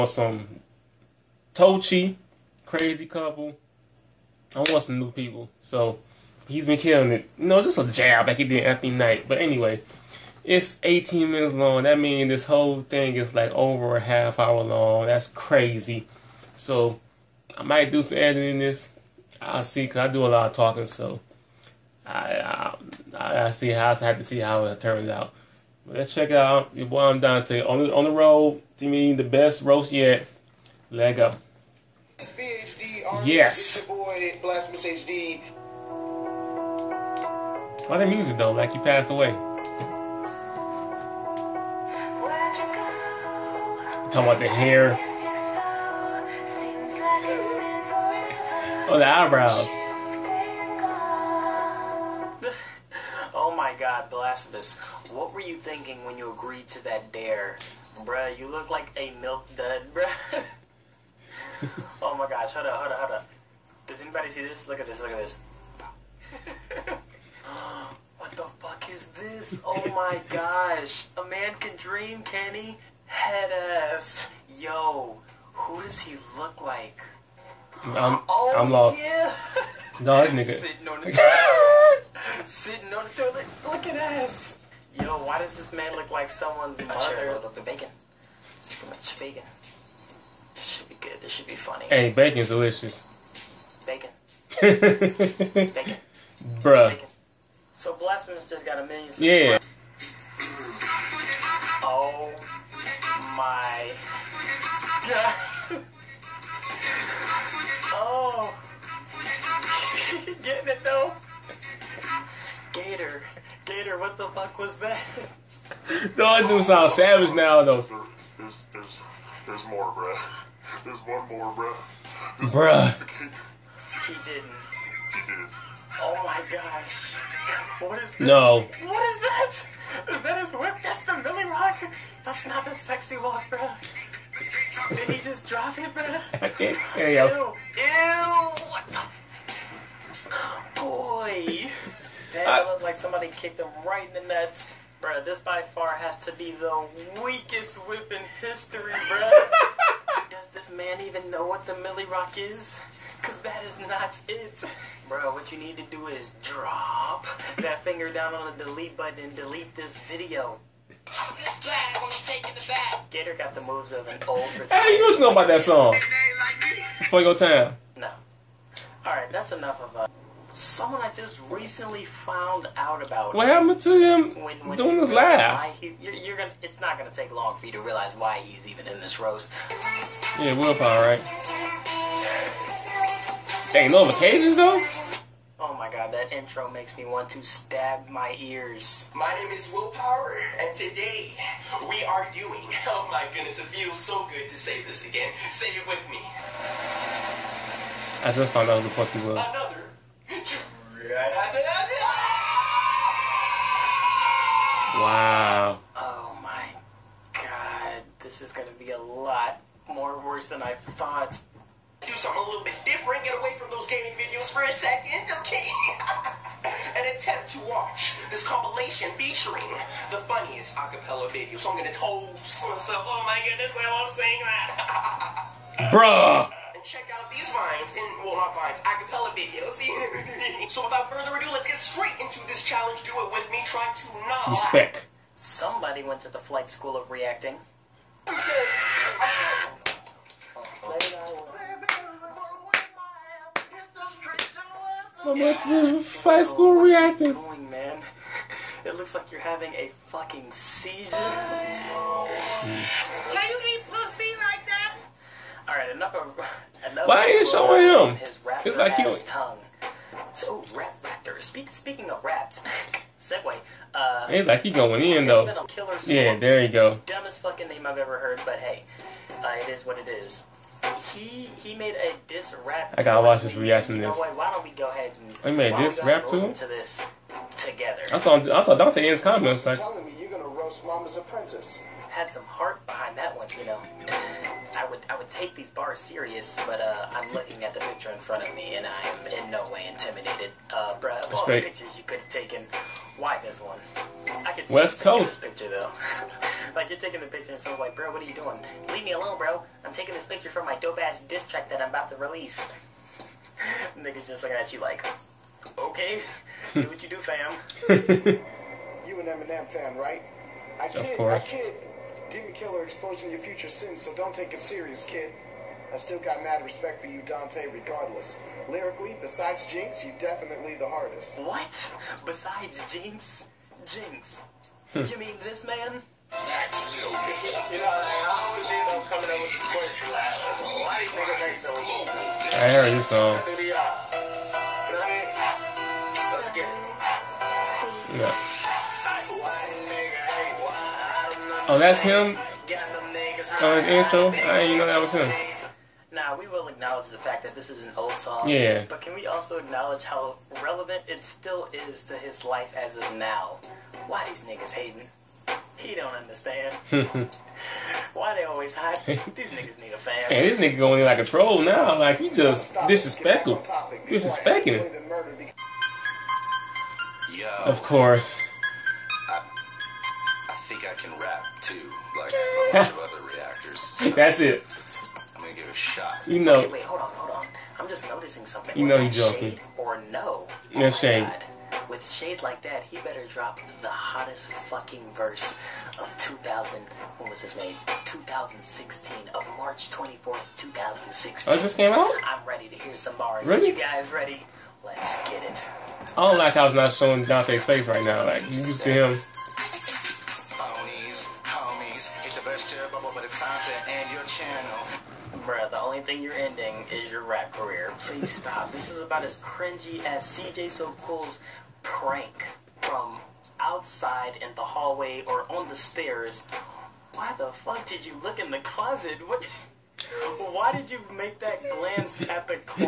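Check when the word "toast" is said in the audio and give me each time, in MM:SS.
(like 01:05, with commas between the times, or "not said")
03:41.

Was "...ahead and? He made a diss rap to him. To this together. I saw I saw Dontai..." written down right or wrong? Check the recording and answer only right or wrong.
right.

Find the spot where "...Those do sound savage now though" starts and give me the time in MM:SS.
01:56.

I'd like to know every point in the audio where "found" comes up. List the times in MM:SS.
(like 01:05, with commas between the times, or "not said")
02:52, 03:18.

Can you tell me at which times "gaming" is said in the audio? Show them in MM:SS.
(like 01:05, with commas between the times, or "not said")
03:33.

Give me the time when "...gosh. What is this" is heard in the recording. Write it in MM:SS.
02:06.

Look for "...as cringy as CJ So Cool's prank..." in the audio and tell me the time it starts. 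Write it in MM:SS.
06:49.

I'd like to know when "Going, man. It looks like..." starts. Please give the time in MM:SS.
04:07.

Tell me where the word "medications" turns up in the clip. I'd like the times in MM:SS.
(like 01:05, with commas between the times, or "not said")
not said.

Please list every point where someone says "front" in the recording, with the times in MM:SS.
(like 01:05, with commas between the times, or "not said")
04:48.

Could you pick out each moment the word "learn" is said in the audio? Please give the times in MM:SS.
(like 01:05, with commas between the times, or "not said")
not said.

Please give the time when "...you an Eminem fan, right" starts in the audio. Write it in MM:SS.
05:09.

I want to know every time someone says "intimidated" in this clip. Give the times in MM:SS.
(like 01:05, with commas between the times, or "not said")
04:49.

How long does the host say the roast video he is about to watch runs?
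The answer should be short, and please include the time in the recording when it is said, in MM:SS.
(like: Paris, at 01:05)
18 minutes, at 00:10.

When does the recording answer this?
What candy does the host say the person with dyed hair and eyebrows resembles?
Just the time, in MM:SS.
00:59.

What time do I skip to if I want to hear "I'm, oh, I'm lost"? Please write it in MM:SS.
01:17.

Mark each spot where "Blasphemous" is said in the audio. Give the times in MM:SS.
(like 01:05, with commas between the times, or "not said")
00:54, 01:37.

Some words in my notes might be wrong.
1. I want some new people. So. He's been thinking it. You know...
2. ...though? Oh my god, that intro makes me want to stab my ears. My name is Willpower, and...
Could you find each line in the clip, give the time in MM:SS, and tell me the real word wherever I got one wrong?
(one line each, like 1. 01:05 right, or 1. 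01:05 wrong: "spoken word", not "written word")
1. 00:04 wrong: "killing", not "thinking"
2. 03:04 right.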